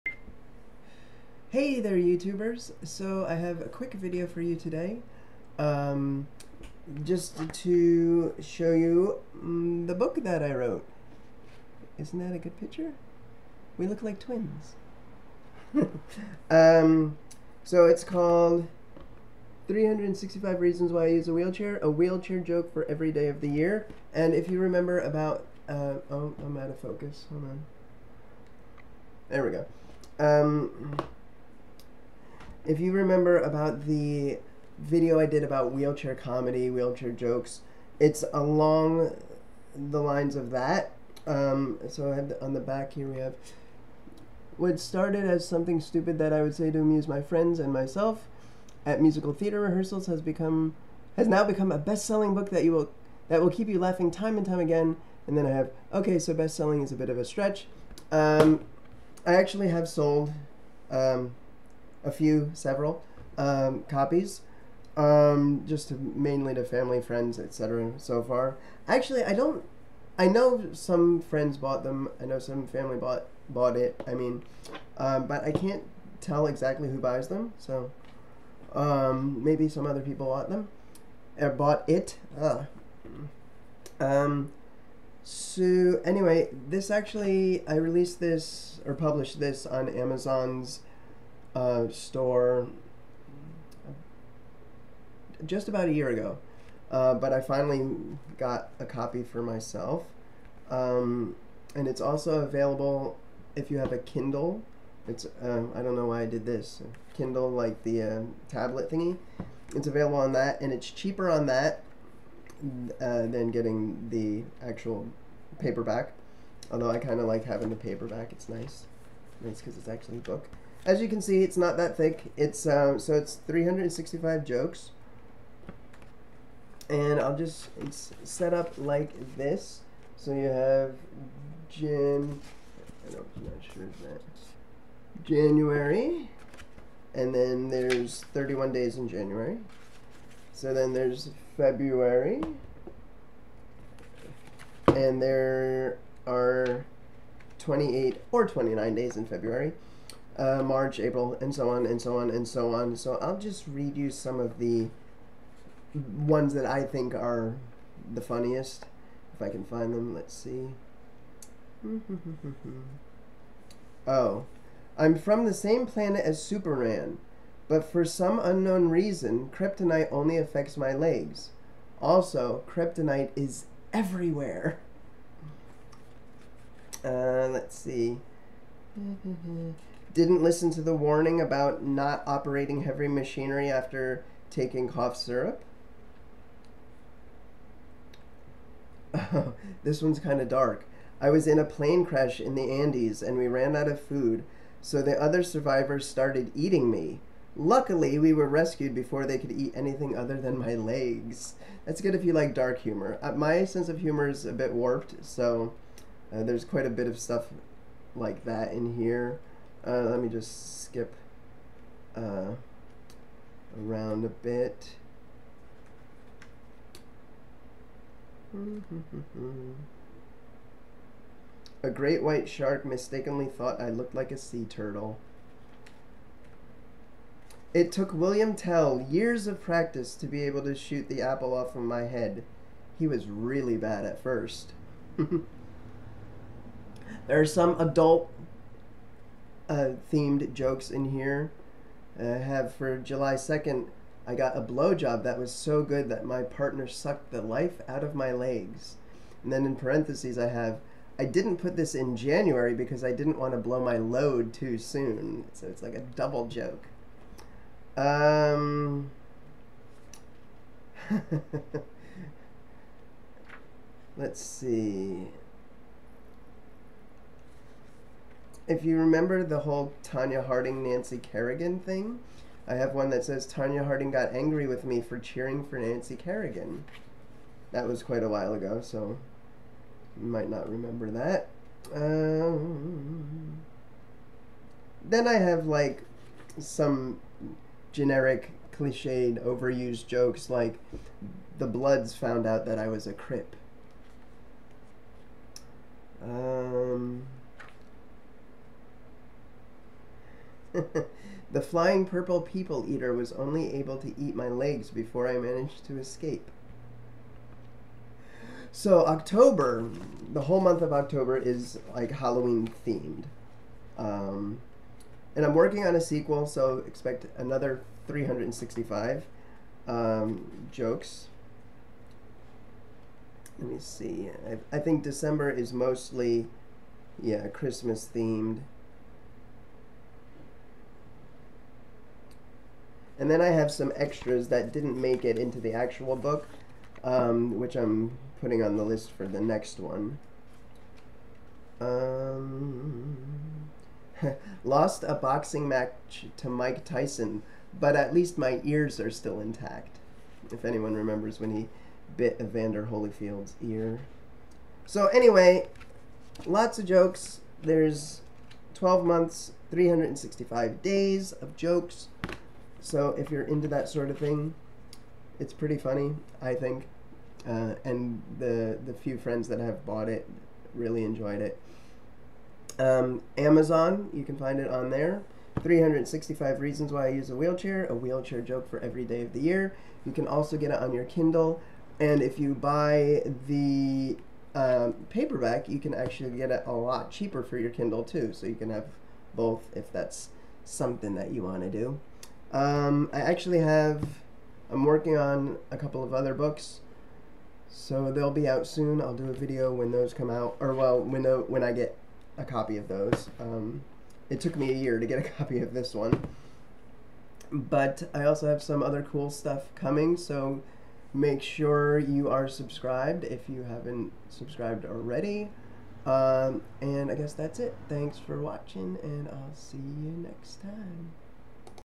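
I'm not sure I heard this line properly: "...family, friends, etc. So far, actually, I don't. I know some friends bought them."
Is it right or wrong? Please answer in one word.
right.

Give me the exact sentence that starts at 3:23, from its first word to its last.
Uh, my sense of humor is a bit warped, so uh, there's quite a bit of stuff like that in here.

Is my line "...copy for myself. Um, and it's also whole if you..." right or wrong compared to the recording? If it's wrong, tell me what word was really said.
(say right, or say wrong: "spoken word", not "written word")
wrong: "available", not "whole".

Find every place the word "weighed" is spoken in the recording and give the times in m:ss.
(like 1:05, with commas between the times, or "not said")
not said.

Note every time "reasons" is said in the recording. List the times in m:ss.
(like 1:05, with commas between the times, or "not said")
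0:20, 2:48, 6:16.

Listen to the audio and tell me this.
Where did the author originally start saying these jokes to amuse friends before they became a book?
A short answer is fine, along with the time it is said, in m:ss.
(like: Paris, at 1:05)
Musical theater rehearsals, at 0:49.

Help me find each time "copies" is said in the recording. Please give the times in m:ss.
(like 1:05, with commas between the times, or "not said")
1:03.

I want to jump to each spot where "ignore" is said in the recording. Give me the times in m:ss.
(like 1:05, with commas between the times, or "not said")
not said.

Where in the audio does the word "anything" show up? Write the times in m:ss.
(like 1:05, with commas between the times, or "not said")
3:19.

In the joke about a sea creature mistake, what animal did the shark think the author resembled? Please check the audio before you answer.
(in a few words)
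Sea turtle.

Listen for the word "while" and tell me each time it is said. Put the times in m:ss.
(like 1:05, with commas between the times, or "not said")
4:38.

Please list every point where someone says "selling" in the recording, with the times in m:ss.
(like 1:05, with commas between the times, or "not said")
0:51, 0:56.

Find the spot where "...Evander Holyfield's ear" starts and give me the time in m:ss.
5:52.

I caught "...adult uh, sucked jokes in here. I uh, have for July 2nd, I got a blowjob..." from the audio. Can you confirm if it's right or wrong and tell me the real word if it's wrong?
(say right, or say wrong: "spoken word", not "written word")
wrong: "themed", not "sucked".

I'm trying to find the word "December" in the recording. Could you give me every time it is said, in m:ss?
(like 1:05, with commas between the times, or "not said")
5:25.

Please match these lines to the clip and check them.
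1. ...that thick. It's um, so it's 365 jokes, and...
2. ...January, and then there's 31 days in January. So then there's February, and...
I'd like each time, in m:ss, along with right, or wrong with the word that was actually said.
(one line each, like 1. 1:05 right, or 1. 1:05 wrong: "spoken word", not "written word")
1. 2:01 right
2. 2:15 right.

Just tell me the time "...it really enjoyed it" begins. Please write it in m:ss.
6:10.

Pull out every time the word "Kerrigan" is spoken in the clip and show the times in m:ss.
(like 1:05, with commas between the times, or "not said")
4:31, 4:36.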